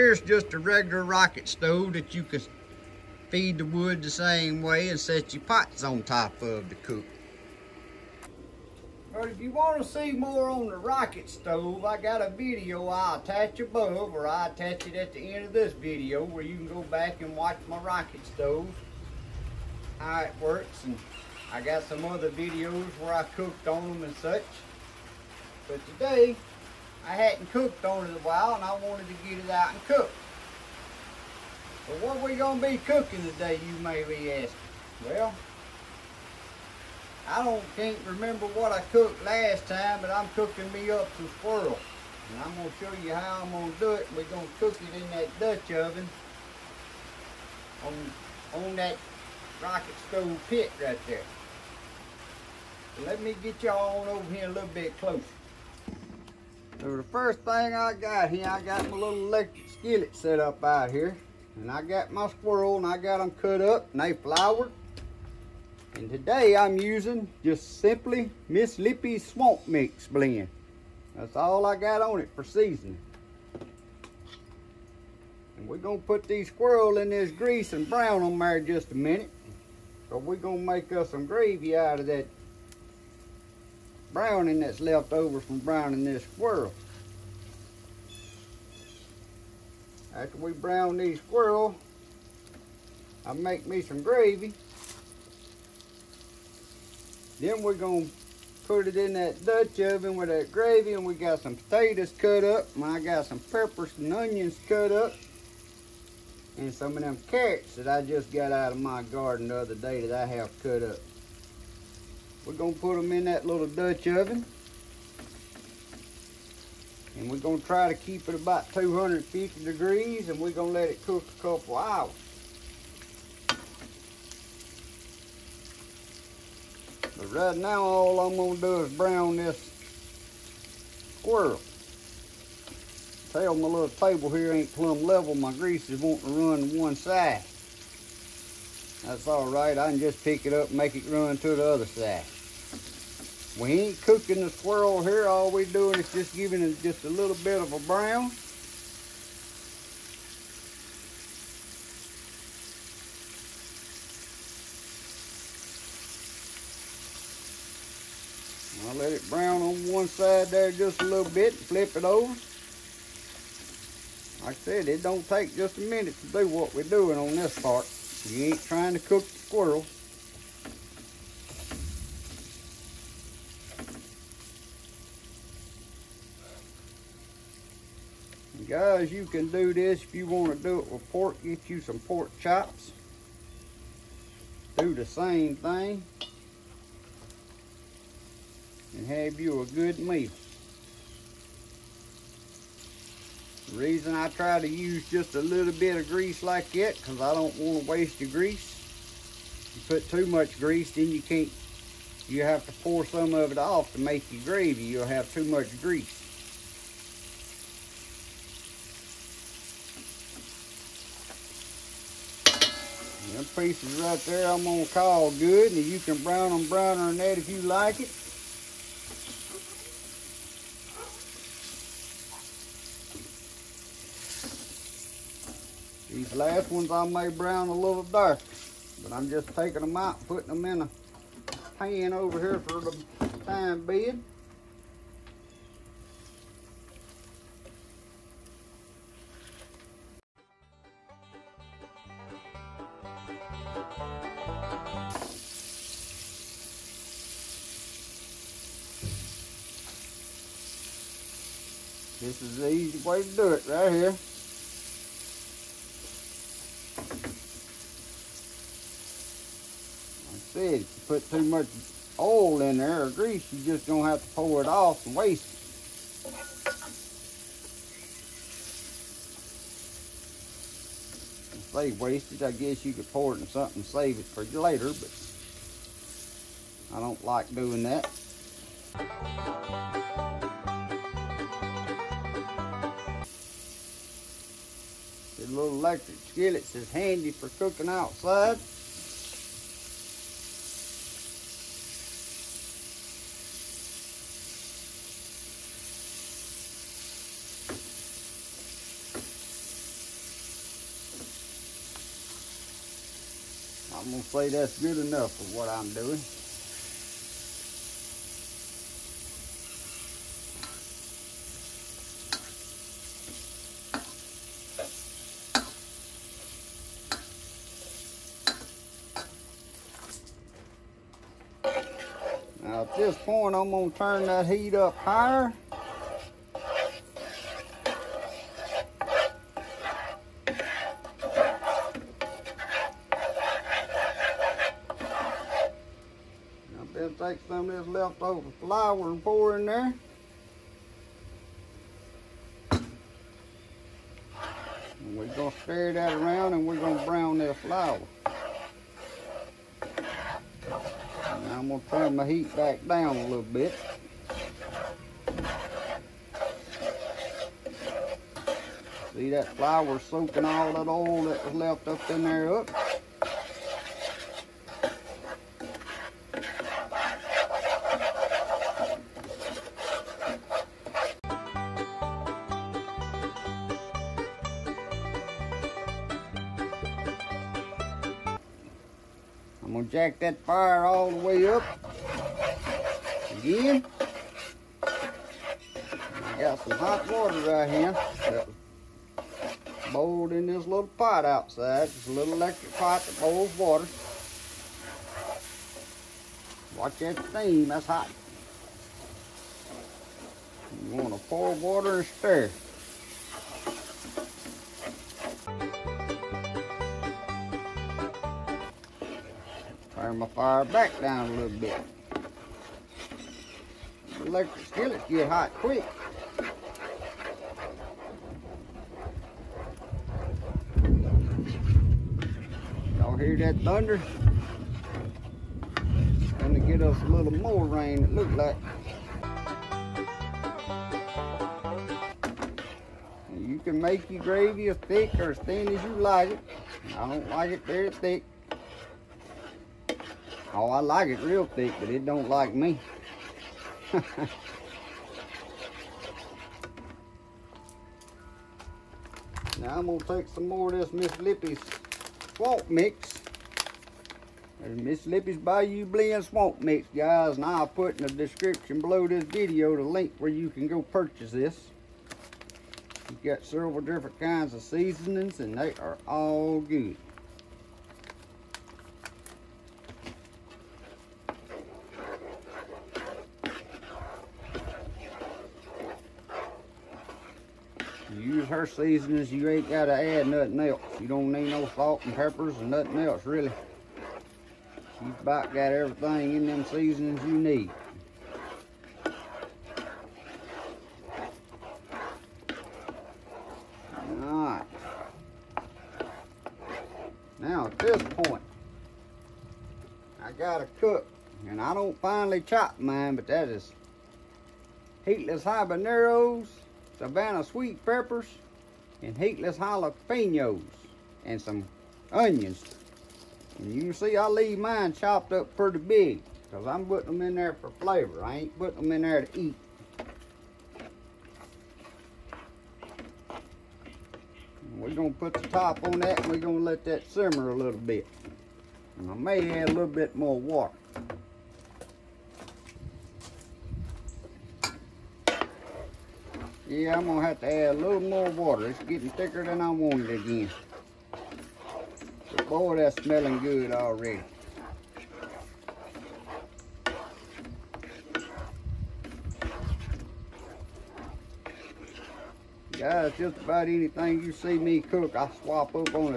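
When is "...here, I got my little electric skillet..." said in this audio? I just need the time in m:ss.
0:58.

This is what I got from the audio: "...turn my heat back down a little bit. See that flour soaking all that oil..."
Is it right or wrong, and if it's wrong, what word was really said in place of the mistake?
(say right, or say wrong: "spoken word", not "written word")
right.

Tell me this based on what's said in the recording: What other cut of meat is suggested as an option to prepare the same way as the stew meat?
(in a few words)
Pork chops.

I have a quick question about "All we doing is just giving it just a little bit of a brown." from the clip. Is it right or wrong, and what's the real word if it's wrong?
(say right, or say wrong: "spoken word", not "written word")
right.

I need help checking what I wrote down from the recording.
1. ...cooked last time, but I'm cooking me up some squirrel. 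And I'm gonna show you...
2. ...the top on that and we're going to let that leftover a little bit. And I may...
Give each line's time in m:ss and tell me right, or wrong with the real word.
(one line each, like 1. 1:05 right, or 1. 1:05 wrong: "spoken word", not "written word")
1. 0:38 right
2. 8:45 wrong: "simmer", not "leftover".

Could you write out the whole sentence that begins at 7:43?
You've got several different kinds of seasonings, and they are all good.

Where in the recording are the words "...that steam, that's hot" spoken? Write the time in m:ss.
6:36.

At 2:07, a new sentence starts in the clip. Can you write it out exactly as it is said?
right now, all I'm gonna do is brown this squirrel.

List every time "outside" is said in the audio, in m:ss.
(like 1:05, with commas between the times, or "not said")
4:47, 6:31.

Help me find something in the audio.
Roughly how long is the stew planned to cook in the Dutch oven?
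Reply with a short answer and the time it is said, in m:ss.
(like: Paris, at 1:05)
A couple hours, at 2:01.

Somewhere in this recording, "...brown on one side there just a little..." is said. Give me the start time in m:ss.
2:39.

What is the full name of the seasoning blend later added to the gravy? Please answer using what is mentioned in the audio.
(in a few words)
Bayou Blend Swamp Mix.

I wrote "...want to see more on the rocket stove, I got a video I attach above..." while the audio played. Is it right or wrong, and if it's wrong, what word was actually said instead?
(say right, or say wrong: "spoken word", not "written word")
right.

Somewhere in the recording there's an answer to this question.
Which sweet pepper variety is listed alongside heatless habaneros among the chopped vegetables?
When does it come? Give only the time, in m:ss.
8:26.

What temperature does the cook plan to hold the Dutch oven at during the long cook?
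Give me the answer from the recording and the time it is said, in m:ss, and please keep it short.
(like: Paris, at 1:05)
250 degrees, at 1:58.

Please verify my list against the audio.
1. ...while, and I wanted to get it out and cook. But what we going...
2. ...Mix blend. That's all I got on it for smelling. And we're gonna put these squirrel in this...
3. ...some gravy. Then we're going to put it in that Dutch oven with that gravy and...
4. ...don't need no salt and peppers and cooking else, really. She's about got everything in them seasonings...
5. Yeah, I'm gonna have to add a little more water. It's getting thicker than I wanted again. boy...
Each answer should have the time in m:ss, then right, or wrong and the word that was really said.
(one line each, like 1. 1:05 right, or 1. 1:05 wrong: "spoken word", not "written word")
1. 0:28 right
2. 1:09 wrong: "seasoning", not "smelling"
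3. 1:33 right
4. 8:01 wrong: "nothing", not "cooking"
5. 8:56 right.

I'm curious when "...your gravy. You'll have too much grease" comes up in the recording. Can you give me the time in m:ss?
3:24.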